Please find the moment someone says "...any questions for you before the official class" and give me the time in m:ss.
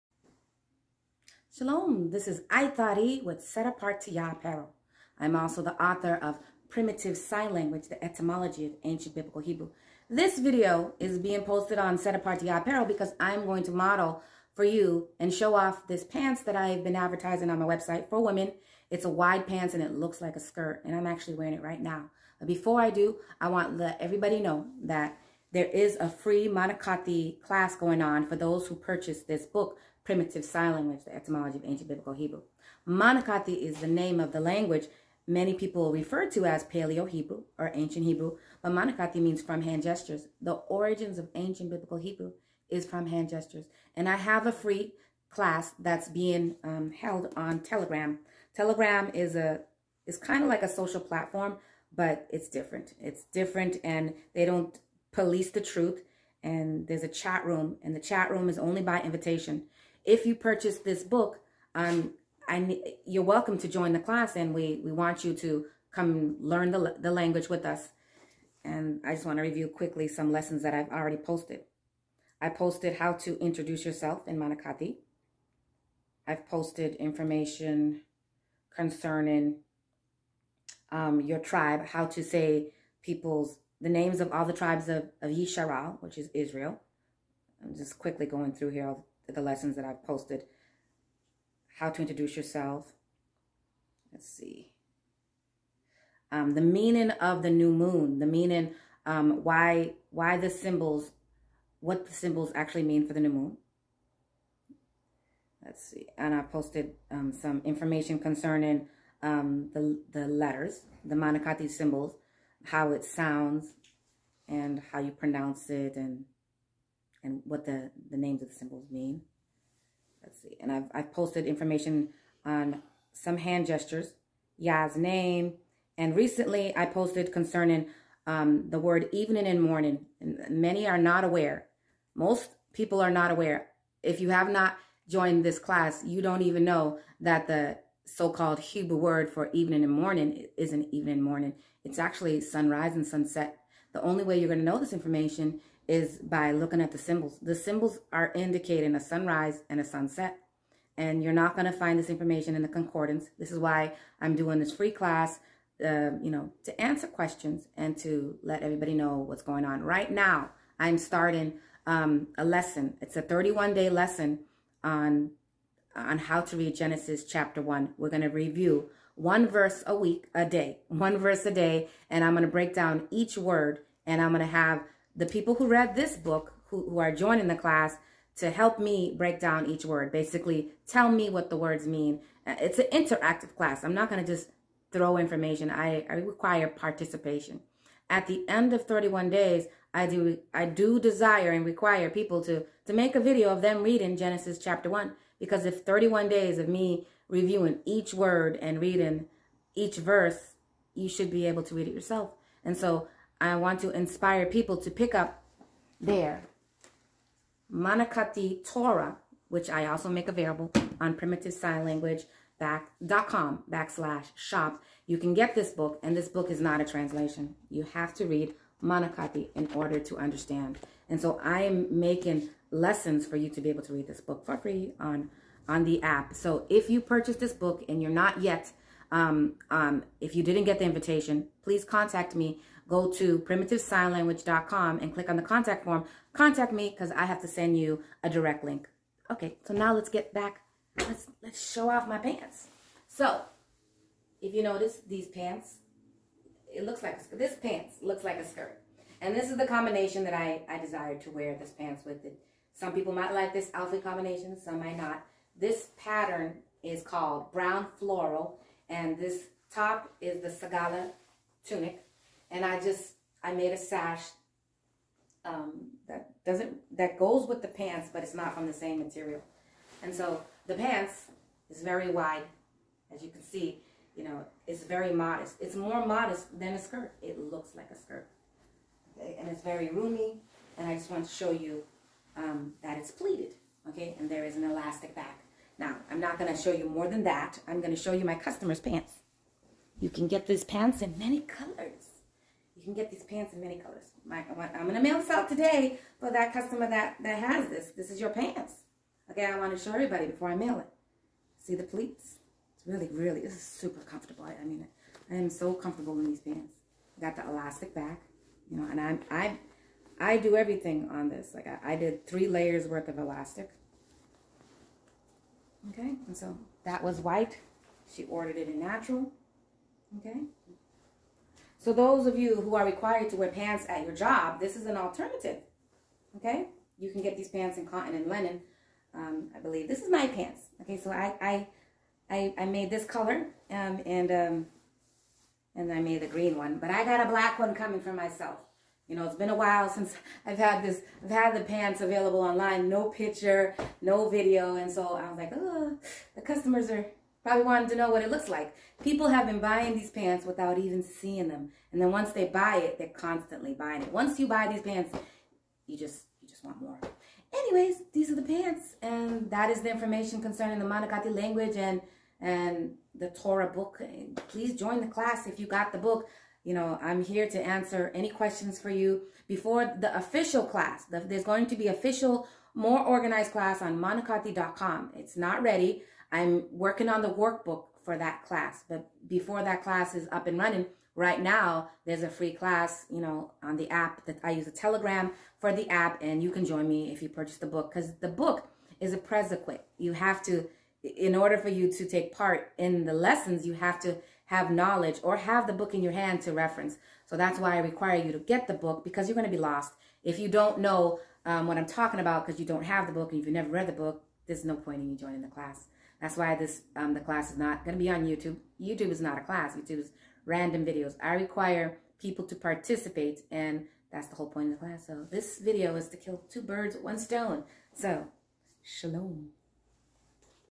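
6:08.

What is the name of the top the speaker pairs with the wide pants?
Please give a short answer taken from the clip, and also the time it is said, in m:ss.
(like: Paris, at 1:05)
Sagala tunic, at 4:20.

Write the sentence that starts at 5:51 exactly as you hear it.
And then once they buy it, they're constantly buying it.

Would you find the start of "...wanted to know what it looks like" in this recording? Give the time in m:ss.
5:47.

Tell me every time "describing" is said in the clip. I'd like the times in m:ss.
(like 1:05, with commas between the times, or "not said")
not said.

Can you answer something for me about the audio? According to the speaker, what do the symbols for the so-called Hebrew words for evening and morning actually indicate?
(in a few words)
sunrise and sunset.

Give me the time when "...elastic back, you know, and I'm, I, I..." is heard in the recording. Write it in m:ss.
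5:07.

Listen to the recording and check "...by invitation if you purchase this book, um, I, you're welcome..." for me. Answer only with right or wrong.
right.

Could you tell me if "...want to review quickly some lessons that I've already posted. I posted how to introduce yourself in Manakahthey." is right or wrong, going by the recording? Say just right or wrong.
right.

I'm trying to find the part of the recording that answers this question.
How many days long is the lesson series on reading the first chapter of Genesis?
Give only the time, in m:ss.
2:43.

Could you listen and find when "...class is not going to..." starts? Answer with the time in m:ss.
6:47.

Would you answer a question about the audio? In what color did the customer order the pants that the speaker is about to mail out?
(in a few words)
natural.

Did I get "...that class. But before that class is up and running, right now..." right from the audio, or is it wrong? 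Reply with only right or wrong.
right.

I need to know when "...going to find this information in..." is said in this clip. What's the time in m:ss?
2:31.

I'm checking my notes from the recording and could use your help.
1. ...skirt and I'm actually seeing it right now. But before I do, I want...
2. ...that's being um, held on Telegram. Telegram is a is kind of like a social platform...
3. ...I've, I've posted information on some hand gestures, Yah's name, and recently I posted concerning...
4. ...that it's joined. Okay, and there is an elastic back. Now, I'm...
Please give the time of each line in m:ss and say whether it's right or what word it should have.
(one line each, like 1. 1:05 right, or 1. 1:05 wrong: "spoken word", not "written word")
1. 0:20 wrong: "wearing", not "seeing"
2. 0:45 right
3. 2:00 right
4. 4:42 wrong: "pleated", not "joined".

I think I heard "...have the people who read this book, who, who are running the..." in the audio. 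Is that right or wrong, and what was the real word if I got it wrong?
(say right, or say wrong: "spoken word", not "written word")
wrong: "joining", not "running".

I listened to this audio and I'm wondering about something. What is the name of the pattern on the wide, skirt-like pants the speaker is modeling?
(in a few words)
brown floral.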